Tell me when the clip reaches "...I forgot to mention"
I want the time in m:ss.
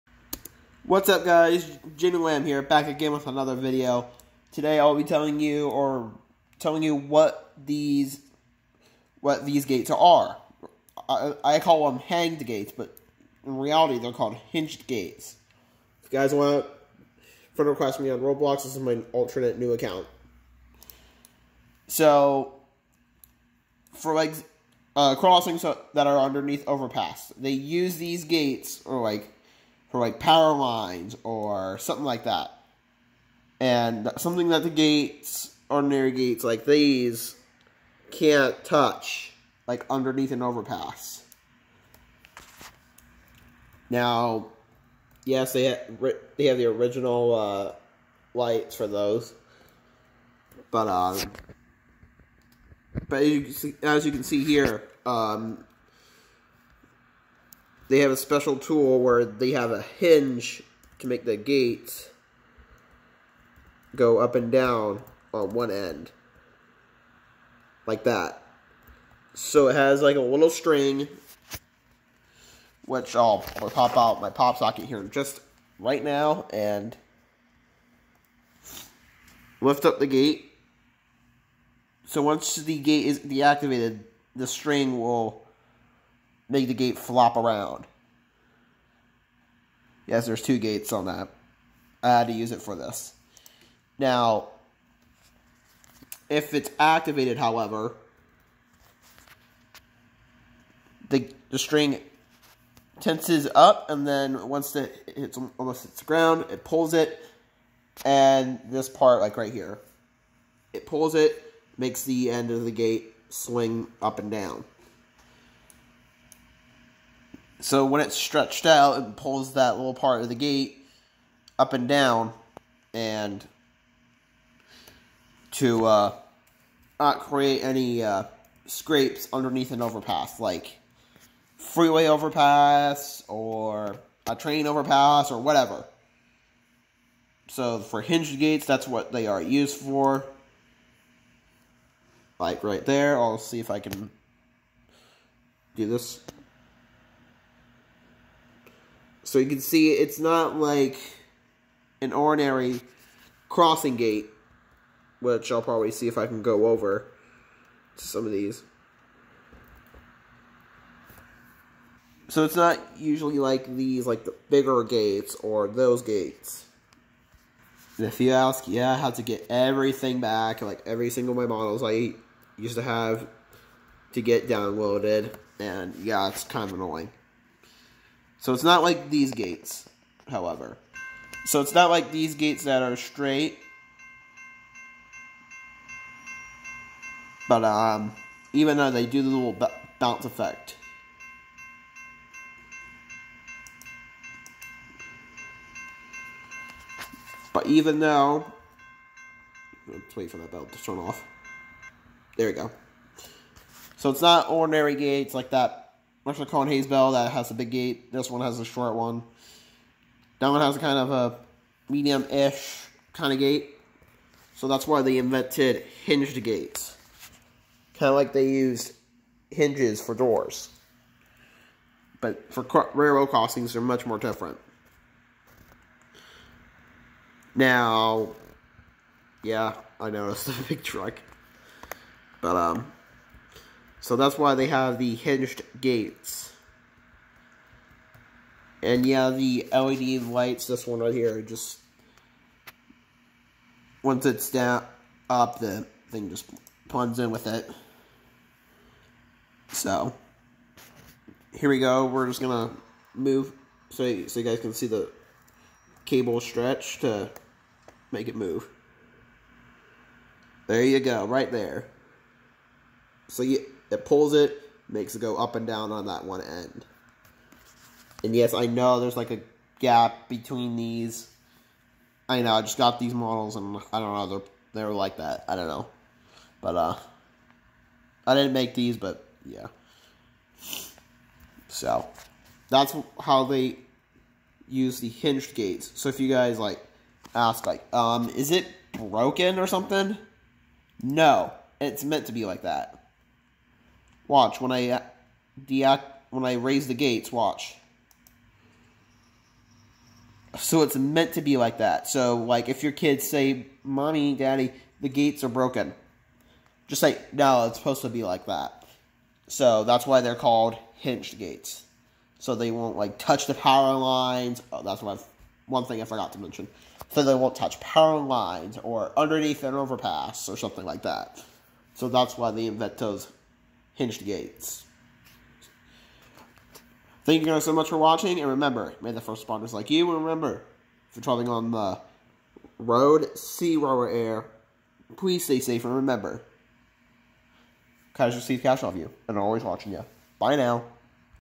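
5:16.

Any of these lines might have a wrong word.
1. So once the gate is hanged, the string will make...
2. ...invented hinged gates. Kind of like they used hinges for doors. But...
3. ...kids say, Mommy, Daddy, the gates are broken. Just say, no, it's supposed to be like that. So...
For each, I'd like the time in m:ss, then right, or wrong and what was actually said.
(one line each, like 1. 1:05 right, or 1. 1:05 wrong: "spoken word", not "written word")
1. 1:22 wrong: "deactivated", not "hanged"
2. 3:35 right
3. 5:02 right.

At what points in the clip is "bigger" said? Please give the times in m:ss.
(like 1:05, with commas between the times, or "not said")
2:44.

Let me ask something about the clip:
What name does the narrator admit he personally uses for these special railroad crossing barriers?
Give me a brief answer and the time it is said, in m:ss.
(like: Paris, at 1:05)
hanged gates, at 0:11.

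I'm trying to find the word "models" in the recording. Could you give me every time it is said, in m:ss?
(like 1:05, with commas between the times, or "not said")
2:51, 4:33.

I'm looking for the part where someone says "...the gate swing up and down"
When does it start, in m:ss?
1:52.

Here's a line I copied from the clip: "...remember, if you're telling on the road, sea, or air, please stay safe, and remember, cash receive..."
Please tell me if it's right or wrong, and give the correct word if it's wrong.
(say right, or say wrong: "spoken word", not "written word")
wrong: "traveling", not "telling".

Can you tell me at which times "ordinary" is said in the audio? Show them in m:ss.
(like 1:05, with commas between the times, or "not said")
0:35, 2:32, 3:24.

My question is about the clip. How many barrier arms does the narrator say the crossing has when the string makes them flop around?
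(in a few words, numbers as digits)
2.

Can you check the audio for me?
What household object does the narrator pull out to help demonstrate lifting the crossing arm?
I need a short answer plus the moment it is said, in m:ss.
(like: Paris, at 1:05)
pop socket, at 1:14.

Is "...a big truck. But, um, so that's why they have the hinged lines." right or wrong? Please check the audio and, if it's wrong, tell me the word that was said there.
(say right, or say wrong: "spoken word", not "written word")
wrong: "gates", not "lines".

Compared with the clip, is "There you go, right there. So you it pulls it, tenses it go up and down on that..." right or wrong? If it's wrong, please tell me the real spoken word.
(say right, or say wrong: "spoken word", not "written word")
wrong: "makes", not "tenses".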